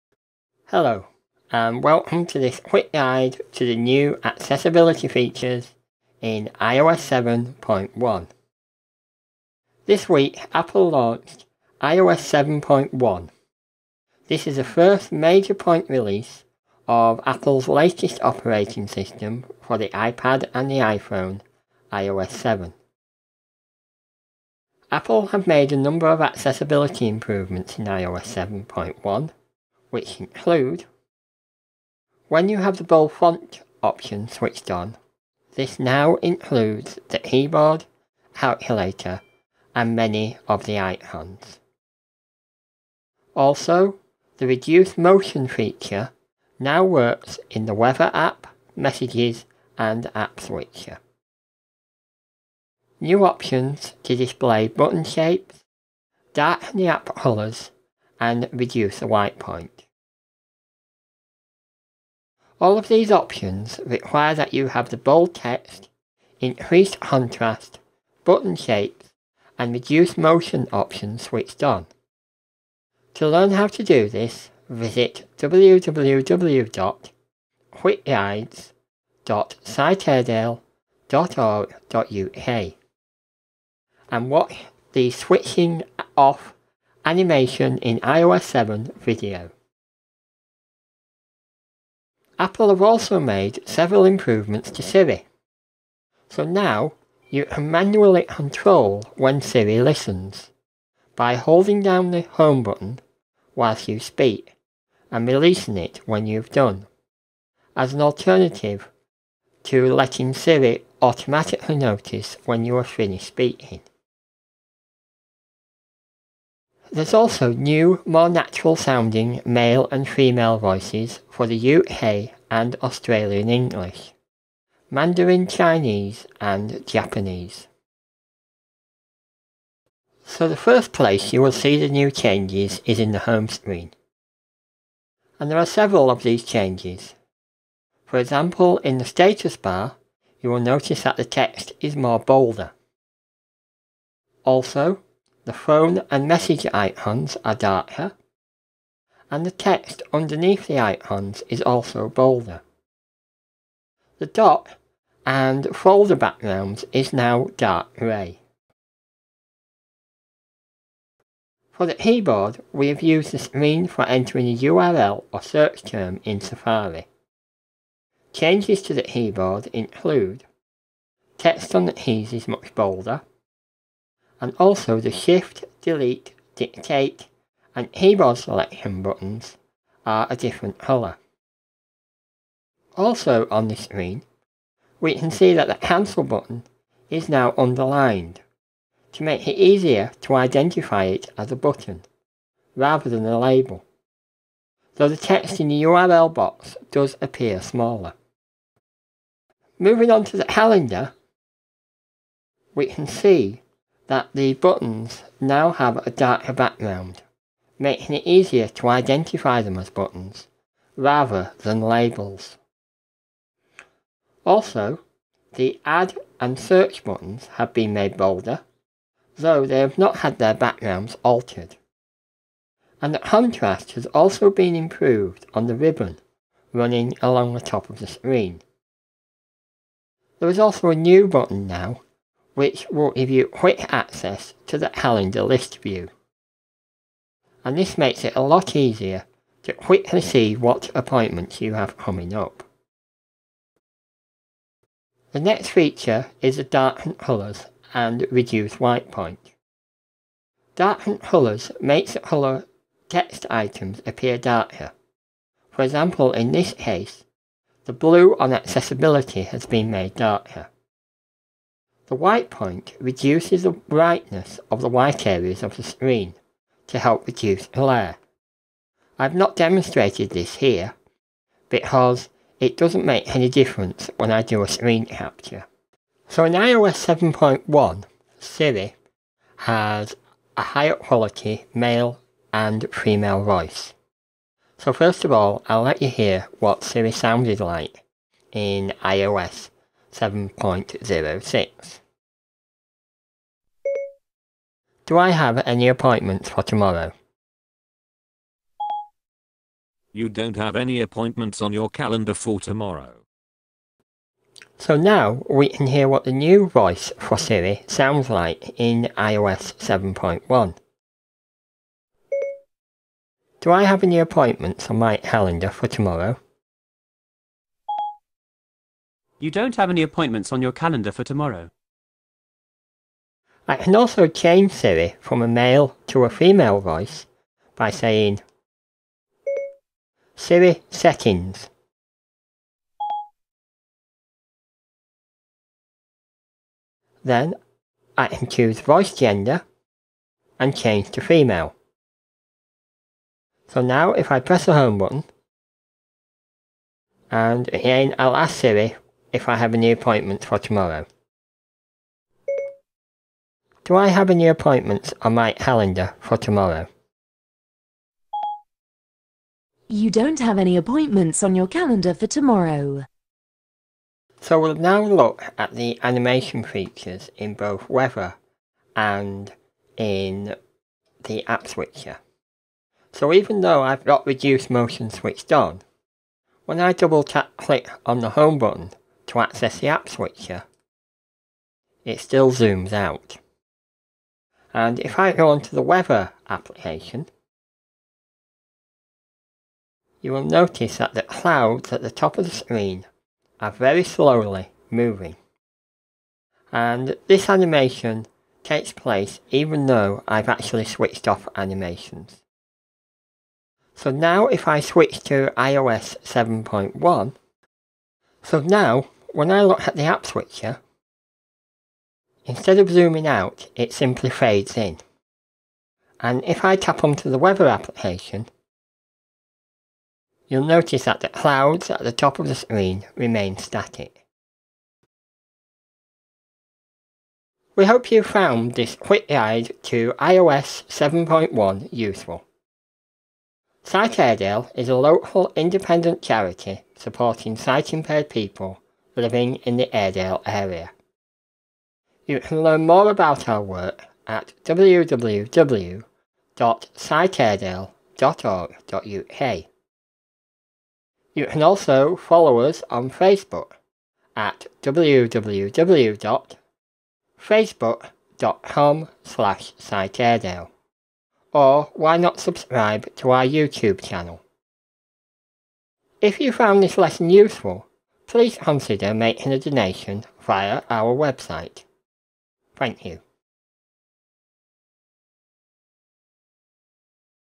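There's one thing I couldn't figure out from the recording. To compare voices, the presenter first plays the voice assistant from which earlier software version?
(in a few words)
iOS 7.06.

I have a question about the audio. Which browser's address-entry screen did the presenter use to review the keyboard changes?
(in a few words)
Safari.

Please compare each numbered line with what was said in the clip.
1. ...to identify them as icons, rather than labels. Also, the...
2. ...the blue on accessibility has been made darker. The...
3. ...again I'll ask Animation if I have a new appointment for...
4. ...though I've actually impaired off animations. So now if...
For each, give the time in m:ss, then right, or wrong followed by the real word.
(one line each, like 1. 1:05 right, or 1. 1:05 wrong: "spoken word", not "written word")
1. 3:28 wrong: "buttons", not "icons"
2. 4:17 right
3. 5:47 wrong: "Siri", not "Animation"
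4. 6:39 wrong: "switched", not "impaired".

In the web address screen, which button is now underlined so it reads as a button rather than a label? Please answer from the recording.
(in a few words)
Cancel.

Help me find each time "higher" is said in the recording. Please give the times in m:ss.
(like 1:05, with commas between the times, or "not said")
4:40.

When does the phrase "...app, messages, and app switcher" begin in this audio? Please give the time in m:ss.
0:48.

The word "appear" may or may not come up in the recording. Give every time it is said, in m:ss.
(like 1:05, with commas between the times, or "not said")
3:17, 4:14.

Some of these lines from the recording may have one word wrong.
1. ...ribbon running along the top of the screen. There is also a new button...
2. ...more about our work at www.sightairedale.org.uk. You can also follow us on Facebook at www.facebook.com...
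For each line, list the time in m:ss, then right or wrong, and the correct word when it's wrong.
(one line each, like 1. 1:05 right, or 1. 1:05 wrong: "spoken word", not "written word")
1. 3:45 right
2. 7:22 right.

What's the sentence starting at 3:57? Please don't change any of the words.
And this makes it a lot easier to quickly see what appointments you have coming up.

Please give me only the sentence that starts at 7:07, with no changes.
We hope you found this quick guide to iOS 7.1 useful.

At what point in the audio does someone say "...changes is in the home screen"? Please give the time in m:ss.
2:12.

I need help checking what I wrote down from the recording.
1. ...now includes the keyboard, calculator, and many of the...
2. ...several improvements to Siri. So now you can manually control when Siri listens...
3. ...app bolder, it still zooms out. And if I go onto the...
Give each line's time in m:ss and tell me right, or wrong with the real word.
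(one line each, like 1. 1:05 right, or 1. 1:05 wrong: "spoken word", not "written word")
1. 0:35 right
2. 1:33 right
3. 6:19 wrong: "switcher", not "bolder".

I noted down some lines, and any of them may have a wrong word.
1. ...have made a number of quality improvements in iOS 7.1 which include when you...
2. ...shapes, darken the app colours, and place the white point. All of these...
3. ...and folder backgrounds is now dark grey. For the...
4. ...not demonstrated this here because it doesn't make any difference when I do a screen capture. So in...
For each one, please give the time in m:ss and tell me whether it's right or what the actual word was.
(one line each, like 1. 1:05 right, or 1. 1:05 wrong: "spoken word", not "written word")
1. 0:25 wrong: "accessibility", not "quality"
2. 0:55 wrong: "reduce", not "place"
3. 2:35 right
4. 4:29 right.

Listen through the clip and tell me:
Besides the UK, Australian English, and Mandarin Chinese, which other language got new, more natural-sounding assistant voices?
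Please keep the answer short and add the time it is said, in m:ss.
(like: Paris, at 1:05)
Japanese, at 2:06.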